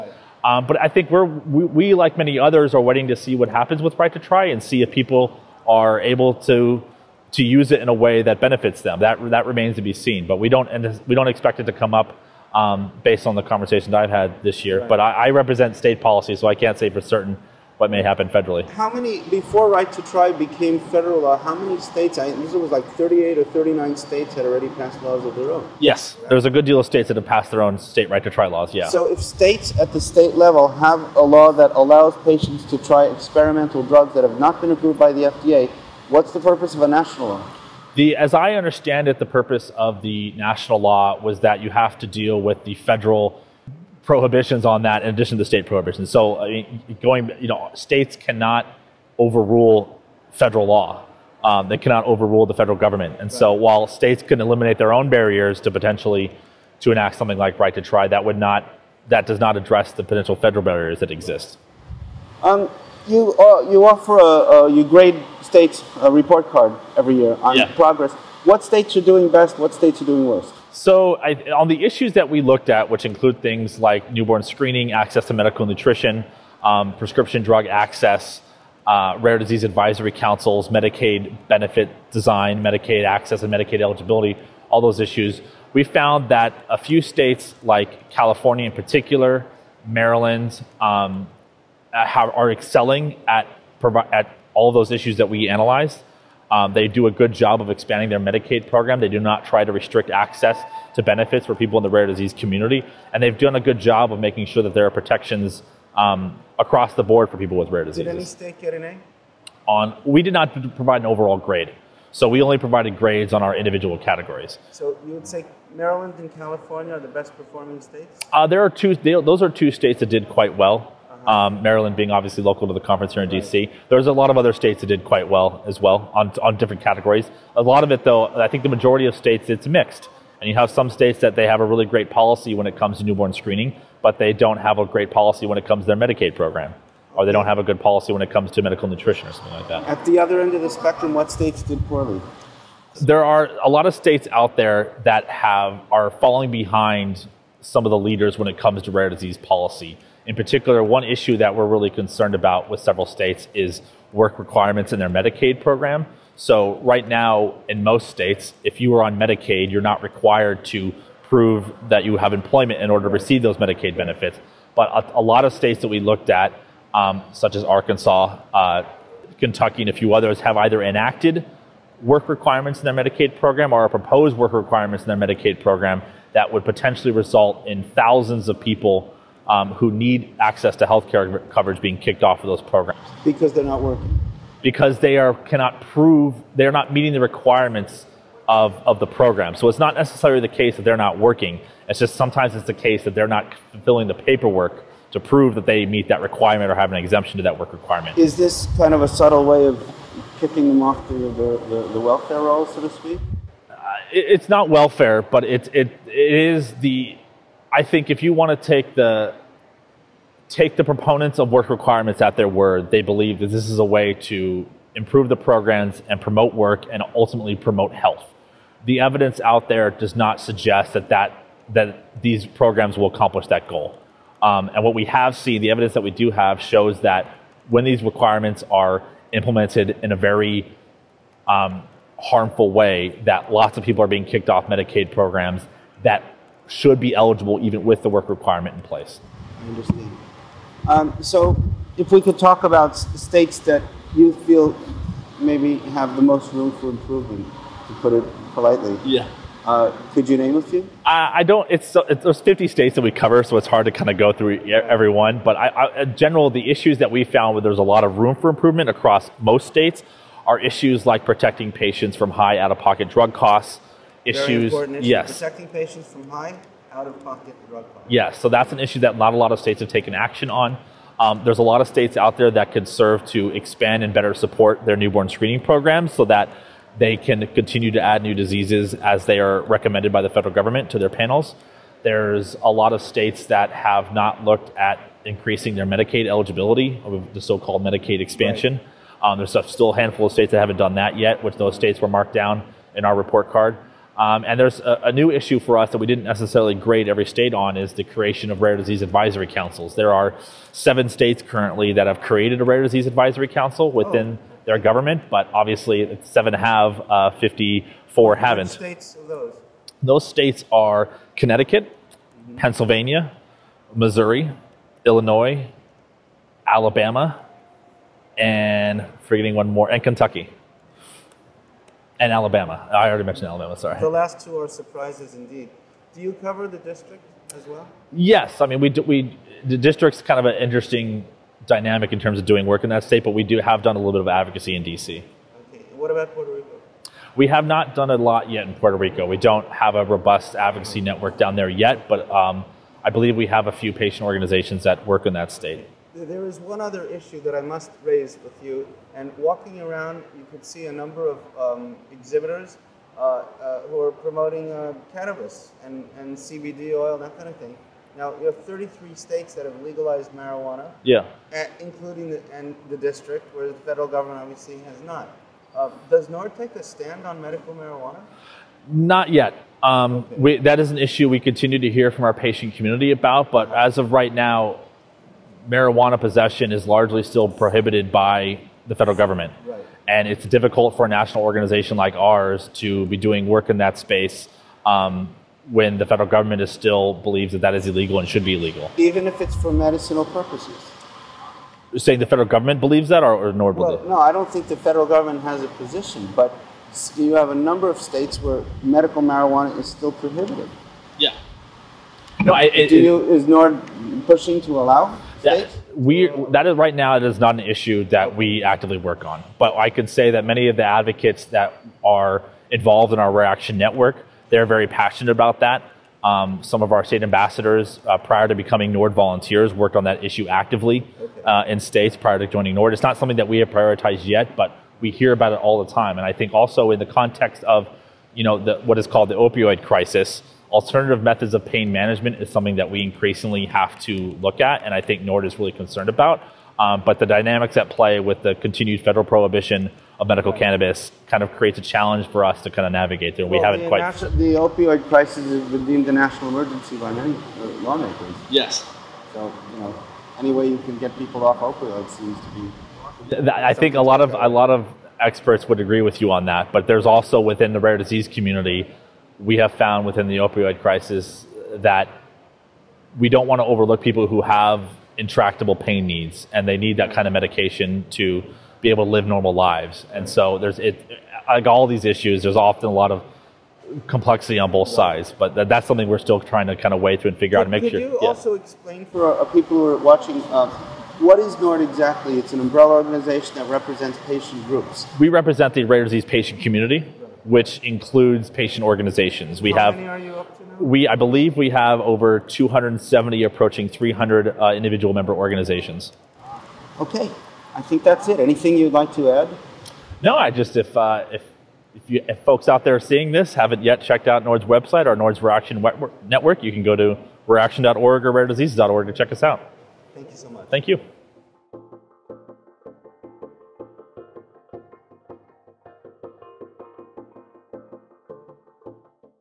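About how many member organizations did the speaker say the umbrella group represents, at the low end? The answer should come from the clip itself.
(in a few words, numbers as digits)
over 270.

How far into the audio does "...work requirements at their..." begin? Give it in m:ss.
3:31.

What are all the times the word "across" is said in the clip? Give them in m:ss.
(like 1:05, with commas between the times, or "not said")
1:46, 4:18.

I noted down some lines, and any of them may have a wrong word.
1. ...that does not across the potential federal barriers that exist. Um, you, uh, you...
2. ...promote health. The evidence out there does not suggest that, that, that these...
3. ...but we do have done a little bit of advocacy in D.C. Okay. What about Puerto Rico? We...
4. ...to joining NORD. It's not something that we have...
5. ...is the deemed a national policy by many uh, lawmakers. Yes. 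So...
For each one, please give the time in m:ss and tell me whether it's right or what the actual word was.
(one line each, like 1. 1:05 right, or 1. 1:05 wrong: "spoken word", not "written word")
1. 0:59 wrong: "address", not "across"
2. 3:37 right
3. 5:33 right
4. 7:02 right
5. 7:25 wrong: "emergency", not "policy".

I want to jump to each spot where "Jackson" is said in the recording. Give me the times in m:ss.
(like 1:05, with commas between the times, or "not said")
not said.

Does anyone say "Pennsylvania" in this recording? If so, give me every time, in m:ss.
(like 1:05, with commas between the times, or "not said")
5:12.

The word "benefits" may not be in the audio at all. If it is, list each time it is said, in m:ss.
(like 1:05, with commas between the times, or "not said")
0:08, 1:21, 1:41, 2:43.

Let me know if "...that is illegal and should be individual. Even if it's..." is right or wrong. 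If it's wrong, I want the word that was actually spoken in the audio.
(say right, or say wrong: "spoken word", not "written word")
wrong: "illegal", not "individual".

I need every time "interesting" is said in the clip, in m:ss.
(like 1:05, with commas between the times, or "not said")
5:30.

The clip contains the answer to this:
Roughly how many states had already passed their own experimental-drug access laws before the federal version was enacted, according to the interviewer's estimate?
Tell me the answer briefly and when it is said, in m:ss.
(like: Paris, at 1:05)
38 or 39, at 0:22.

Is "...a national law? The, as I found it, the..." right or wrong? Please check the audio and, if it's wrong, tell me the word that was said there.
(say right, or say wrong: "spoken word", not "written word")
wrong: "understand", not "found".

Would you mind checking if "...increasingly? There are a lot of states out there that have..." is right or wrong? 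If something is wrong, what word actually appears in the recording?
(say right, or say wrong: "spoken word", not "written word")
wrong: "poorly", not "increasingly".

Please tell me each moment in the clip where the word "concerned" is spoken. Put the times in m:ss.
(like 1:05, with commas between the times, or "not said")
2:31, 7:15.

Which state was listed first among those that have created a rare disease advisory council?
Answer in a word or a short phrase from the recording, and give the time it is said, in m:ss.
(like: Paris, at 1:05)
Connecticut, at 5:11.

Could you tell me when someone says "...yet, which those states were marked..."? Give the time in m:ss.
4:51.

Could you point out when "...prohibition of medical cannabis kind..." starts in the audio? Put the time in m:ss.
7:19.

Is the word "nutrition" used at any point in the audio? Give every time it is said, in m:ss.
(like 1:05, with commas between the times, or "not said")
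1:15, 2:18.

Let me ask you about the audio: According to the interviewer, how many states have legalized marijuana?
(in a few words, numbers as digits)
33.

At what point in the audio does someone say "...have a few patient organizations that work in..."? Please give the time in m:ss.
5:43.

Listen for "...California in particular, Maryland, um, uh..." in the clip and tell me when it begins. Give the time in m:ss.
1:28.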